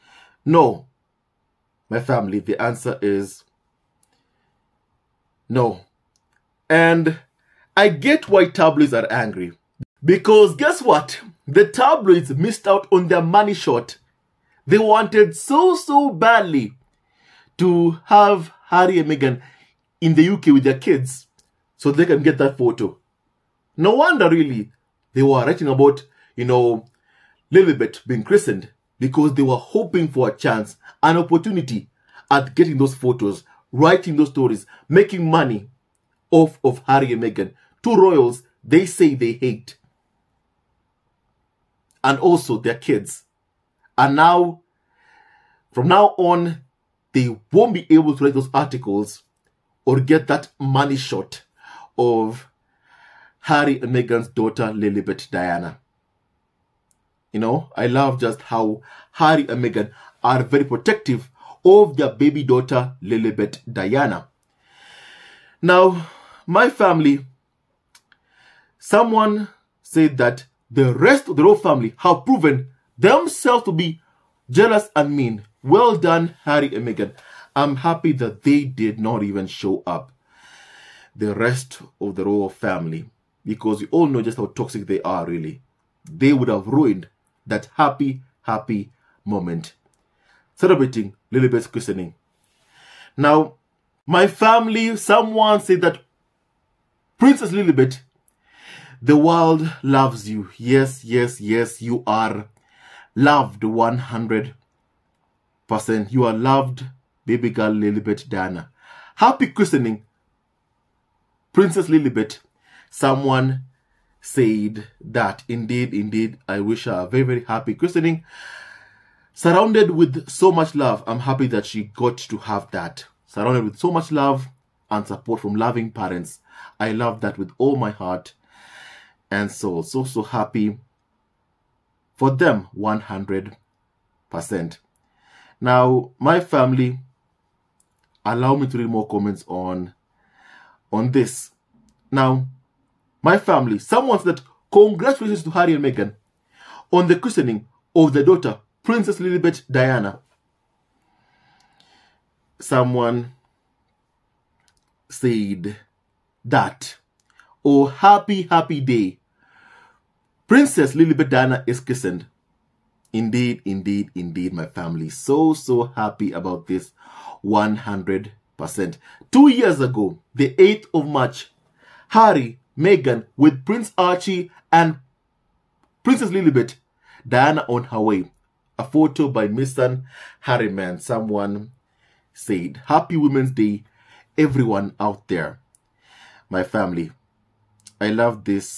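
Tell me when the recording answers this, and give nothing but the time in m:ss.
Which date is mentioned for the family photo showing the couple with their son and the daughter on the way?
2:50.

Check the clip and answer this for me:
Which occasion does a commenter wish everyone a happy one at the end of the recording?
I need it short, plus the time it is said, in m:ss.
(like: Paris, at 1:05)
Women's Day, at 3:03.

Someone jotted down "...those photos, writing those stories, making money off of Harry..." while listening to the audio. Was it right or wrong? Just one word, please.
right.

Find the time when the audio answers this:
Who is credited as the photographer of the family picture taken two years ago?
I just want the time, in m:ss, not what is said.
2:59.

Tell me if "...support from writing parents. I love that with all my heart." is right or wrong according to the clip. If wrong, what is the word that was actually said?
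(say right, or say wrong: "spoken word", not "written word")
wrong: "loving", not "writing".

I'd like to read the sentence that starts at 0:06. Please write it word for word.
And I get why tabloids are angry.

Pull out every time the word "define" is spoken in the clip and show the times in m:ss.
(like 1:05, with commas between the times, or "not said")
not said.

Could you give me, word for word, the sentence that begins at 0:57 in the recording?
You know, I love just how Harry and Meghan are very protective of their baby daughter, Lilibet Diana.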